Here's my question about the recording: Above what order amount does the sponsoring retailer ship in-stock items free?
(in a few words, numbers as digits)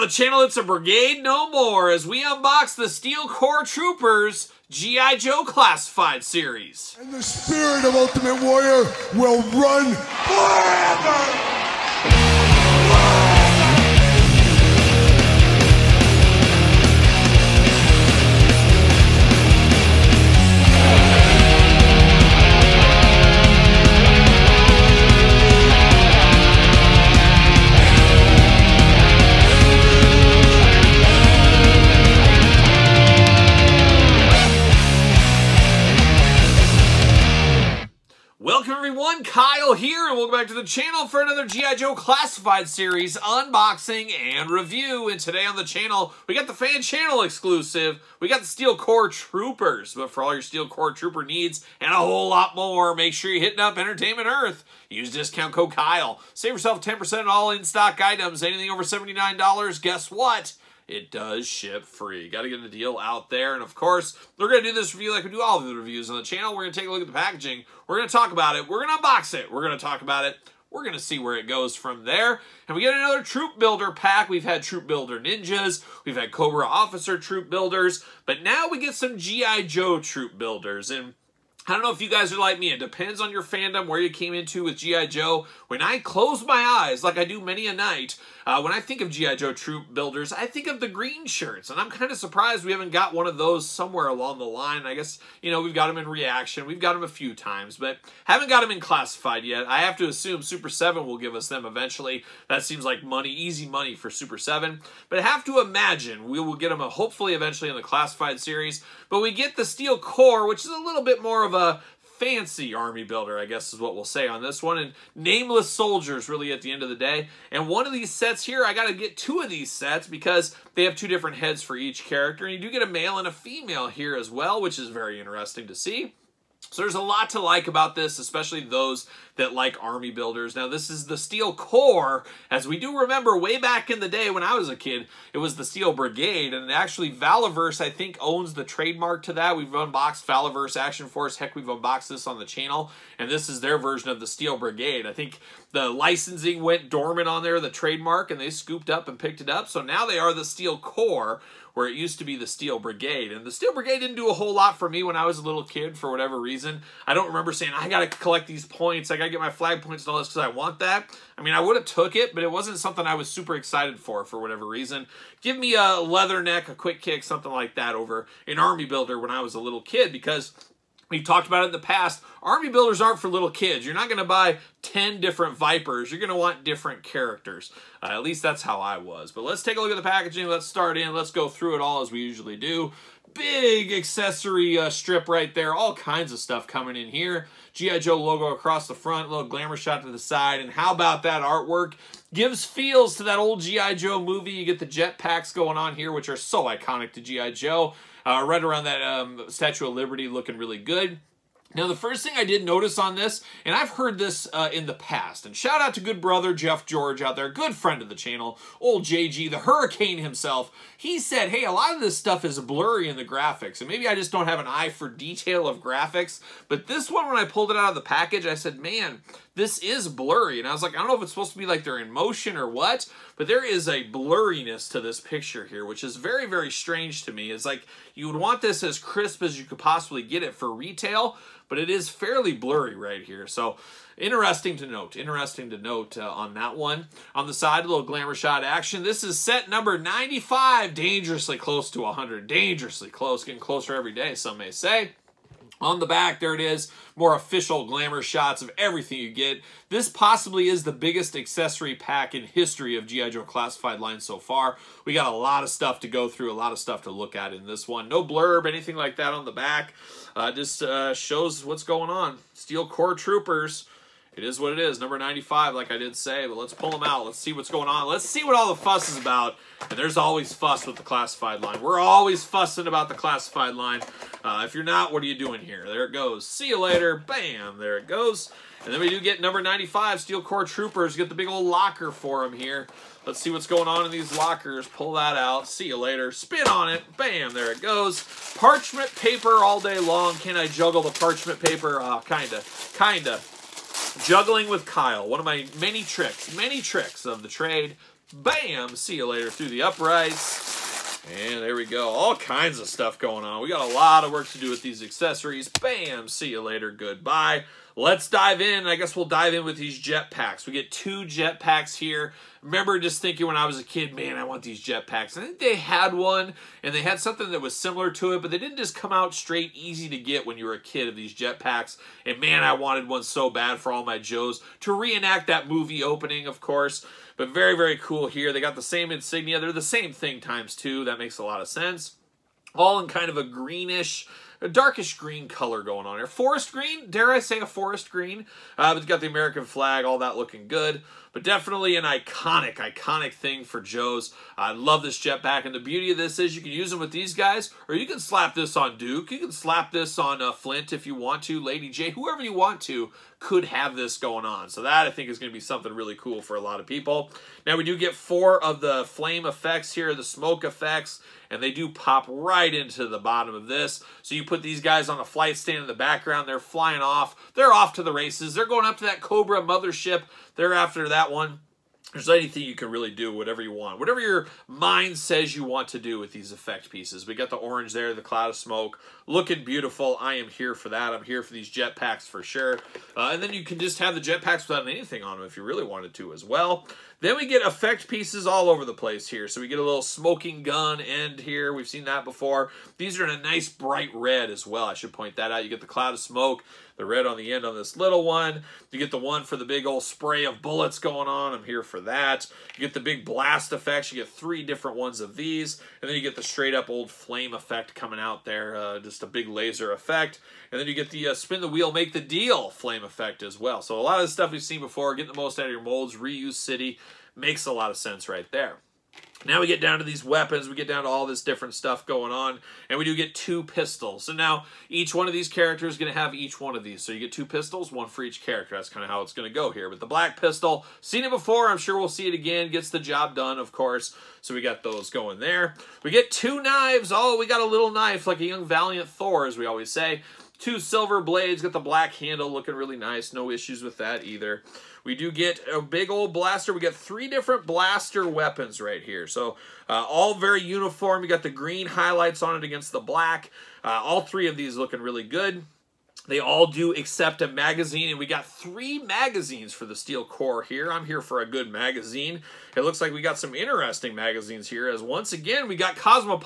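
$79.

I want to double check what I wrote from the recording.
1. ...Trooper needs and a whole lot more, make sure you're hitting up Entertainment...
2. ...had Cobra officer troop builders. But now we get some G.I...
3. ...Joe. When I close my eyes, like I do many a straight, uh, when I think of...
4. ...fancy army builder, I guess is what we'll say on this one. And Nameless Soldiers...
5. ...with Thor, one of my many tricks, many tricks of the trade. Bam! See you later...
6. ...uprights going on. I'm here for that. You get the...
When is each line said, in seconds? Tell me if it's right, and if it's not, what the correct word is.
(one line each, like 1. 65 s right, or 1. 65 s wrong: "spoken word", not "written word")
1. 50 s right
2. 76 s right
3. 85 s wrong: "night", not "straight"
4. 112 s right
5. 294 s wrong: "Kyle", not "Thor"
6. 400 s wrong: "bullets", not "uprights".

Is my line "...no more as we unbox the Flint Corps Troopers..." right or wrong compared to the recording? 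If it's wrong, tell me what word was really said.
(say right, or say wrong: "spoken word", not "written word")
wrong: "Steel", not "Flint".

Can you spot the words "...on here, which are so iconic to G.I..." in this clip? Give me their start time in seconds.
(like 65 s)
195 s.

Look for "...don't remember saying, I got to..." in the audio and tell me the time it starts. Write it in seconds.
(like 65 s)
157 s.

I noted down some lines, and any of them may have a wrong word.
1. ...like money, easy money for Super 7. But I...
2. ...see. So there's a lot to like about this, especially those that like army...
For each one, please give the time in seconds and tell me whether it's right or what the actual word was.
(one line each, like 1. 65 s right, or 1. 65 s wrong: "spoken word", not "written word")
1. 102 s right
2. 125 s right.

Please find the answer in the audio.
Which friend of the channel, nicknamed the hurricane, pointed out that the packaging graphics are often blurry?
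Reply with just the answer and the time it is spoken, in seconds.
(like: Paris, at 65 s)
Jeff George, at 206 s.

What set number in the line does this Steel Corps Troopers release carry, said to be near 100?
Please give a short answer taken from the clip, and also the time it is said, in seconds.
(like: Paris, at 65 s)
95, at 239 s.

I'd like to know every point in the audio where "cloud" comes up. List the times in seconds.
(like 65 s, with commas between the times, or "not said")
378 s, 395 s.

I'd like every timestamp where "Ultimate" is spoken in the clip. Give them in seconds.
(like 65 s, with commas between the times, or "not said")
7 s.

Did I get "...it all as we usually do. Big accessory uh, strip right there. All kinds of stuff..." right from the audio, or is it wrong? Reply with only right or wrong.
right.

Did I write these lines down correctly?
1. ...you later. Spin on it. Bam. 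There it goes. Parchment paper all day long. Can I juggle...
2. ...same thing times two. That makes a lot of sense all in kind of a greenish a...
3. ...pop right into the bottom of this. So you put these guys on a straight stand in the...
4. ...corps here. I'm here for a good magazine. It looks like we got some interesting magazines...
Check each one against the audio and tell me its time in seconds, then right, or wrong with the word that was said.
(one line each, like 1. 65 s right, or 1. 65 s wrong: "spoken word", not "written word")
1. 285 s right
2. 329 s right
3. 361 s wrong: "flight", not "straight"
4. 460 s right.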